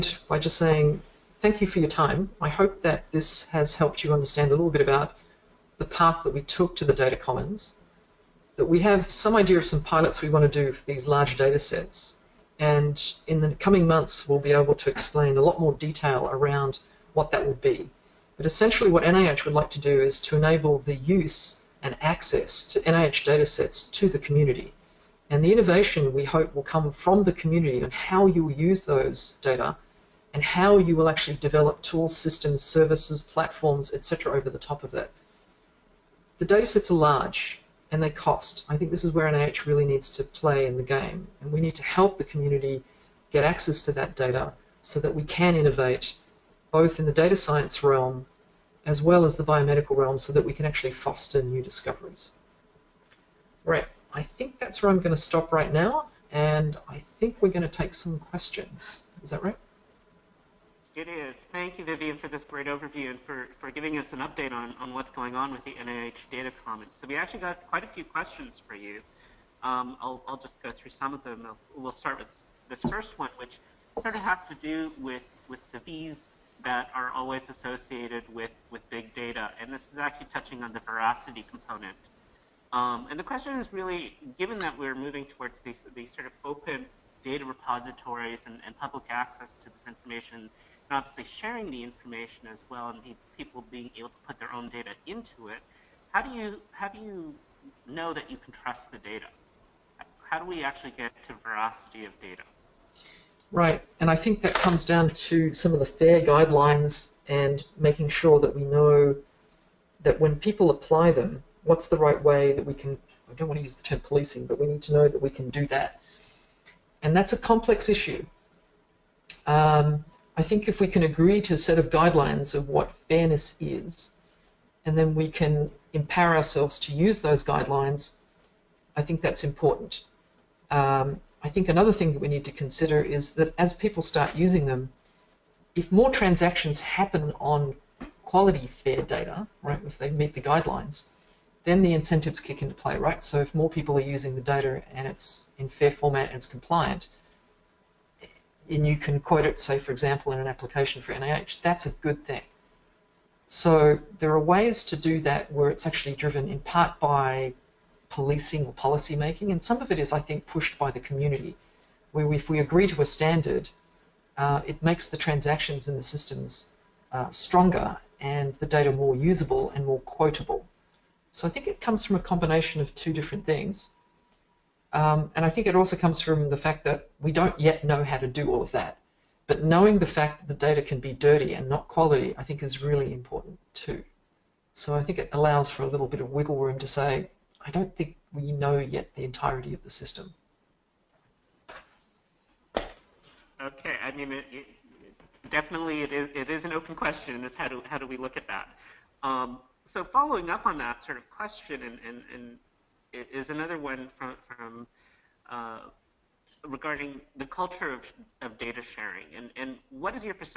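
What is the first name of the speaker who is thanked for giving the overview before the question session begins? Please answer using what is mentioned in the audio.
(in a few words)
Vivien.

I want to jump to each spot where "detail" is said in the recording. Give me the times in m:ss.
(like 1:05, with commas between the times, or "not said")
0:15.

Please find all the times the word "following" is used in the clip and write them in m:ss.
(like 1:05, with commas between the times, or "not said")
3:20.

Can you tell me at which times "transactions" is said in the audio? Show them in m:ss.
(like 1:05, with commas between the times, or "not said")
2:16, 2:45.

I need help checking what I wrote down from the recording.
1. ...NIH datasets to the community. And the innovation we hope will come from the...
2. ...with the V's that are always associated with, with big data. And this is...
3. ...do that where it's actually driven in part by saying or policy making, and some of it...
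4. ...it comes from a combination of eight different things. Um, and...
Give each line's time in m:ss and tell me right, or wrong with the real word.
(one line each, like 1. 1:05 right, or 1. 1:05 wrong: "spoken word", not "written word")
1. 0:22 right
2. 1:15 right
3. 2:34 wrong: "policing", not "saying"
4. 2:51 wrong: "two", not "eight".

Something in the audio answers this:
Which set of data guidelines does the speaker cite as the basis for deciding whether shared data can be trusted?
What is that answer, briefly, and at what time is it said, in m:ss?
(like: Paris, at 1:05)
FAIR guidelines, at 1:45.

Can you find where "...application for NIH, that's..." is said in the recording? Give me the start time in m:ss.
2:30.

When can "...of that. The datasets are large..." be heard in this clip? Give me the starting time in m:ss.
0:34.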